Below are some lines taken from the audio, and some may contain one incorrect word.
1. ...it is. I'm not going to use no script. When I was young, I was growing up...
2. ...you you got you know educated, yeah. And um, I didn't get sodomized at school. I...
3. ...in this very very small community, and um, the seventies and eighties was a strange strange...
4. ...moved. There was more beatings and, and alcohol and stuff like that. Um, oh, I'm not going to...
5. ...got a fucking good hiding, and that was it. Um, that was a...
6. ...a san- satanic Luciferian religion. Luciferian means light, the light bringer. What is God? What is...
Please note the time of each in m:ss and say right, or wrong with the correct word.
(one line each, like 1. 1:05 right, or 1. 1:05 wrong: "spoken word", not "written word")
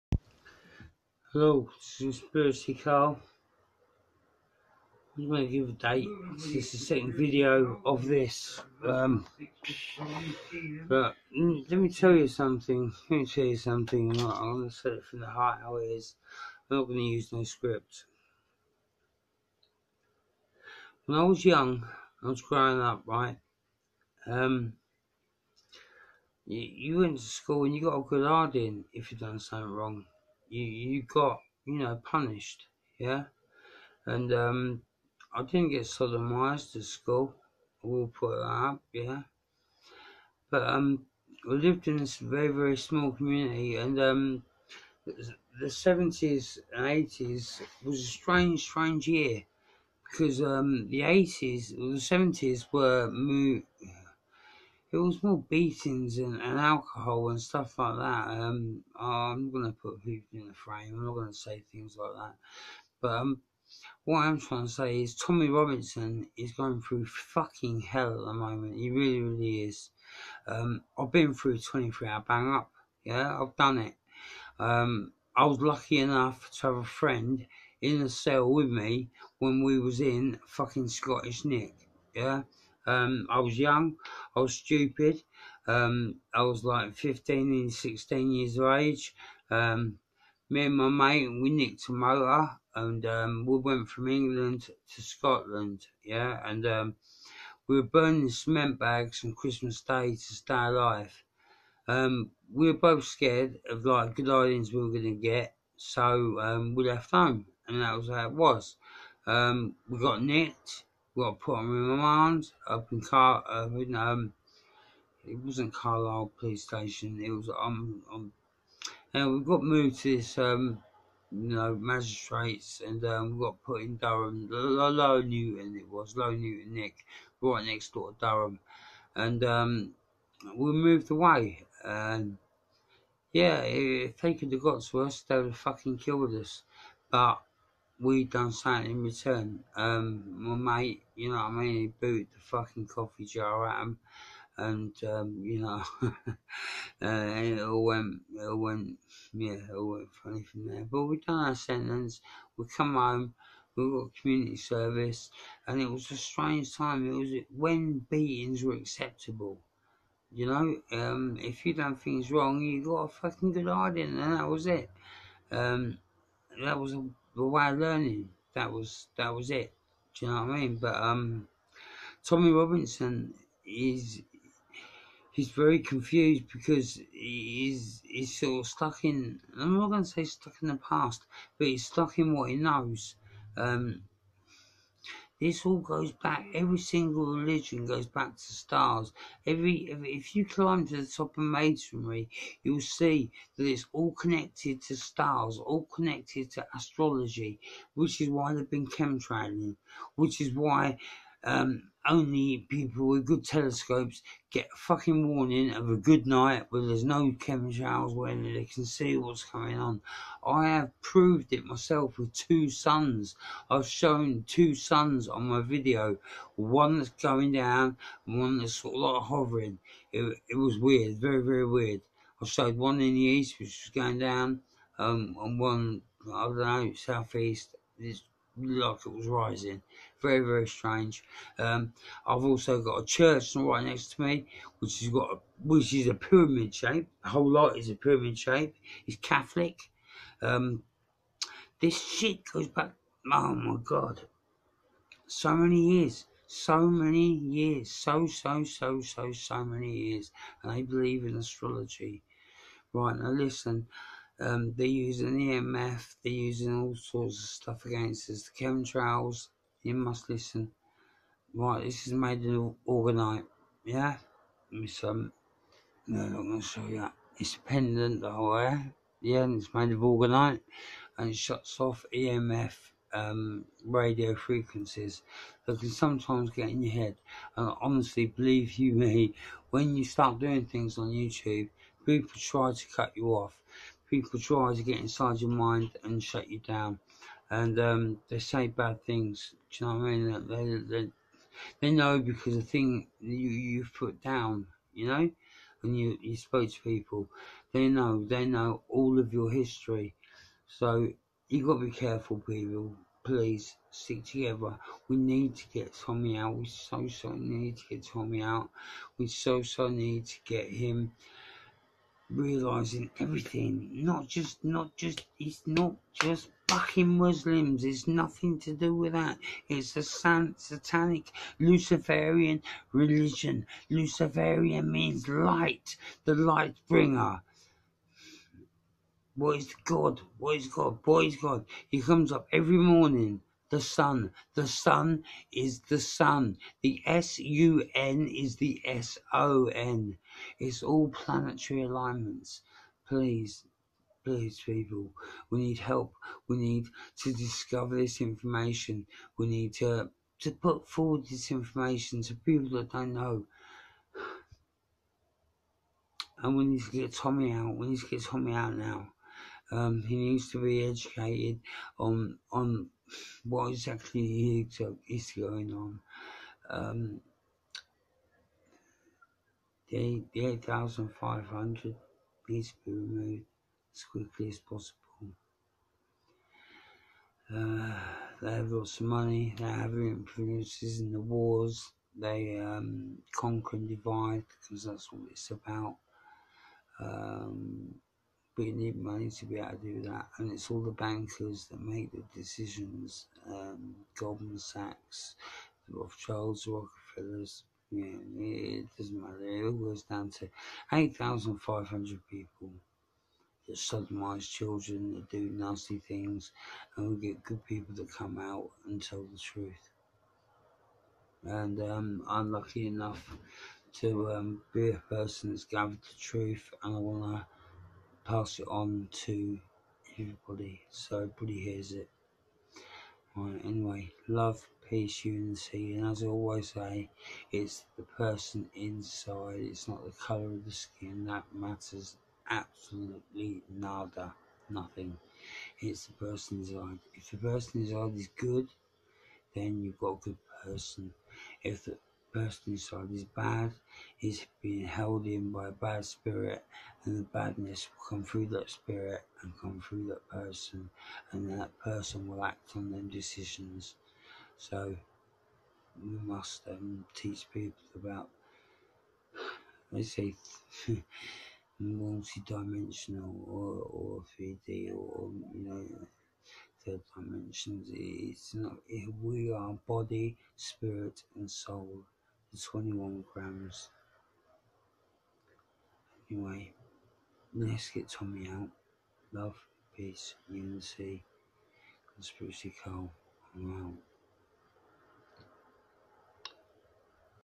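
1. 0:15 right
2. 0:30 wrong: "punished", not "educated"
3. 0:41 right
4. 0:53 right
5. 2:42 right
6. 5:19 right.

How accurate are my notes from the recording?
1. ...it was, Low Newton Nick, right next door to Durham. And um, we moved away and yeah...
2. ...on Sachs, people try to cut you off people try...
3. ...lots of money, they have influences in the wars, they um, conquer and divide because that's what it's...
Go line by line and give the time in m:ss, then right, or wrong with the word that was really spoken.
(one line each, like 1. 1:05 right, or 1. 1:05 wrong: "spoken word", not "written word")
1. 2:05 right
2. 4:40 wrong: "YouTube", not "Sachs"
3. 6:18 right.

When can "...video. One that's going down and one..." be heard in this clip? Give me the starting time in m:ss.
3:35.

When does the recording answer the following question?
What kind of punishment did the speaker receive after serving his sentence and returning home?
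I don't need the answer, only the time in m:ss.
2:34.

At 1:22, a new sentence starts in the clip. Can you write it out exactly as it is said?
Yeah, um, I was young, I was stupid.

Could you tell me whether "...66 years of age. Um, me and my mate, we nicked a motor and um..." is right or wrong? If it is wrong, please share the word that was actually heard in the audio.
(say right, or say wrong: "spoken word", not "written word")
wrong: "16", not "66".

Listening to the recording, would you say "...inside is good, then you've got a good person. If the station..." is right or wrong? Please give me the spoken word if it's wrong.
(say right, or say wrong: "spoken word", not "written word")
wrong: "person", not "station".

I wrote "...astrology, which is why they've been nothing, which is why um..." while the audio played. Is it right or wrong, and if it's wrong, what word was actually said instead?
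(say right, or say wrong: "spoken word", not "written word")
wrong: "chemtrailing", not "nothing".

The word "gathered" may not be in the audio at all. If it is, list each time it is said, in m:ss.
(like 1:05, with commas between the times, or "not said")
6:55.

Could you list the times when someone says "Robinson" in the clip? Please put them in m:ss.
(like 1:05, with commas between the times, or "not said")
1:05, 2:52.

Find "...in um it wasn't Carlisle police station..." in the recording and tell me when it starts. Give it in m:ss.
1:53.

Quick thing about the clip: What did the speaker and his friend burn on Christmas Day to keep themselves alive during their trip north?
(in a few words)
Cement bags.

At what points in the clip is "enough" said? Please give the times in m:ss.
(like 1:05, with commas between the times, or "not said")
1:15, 6:52.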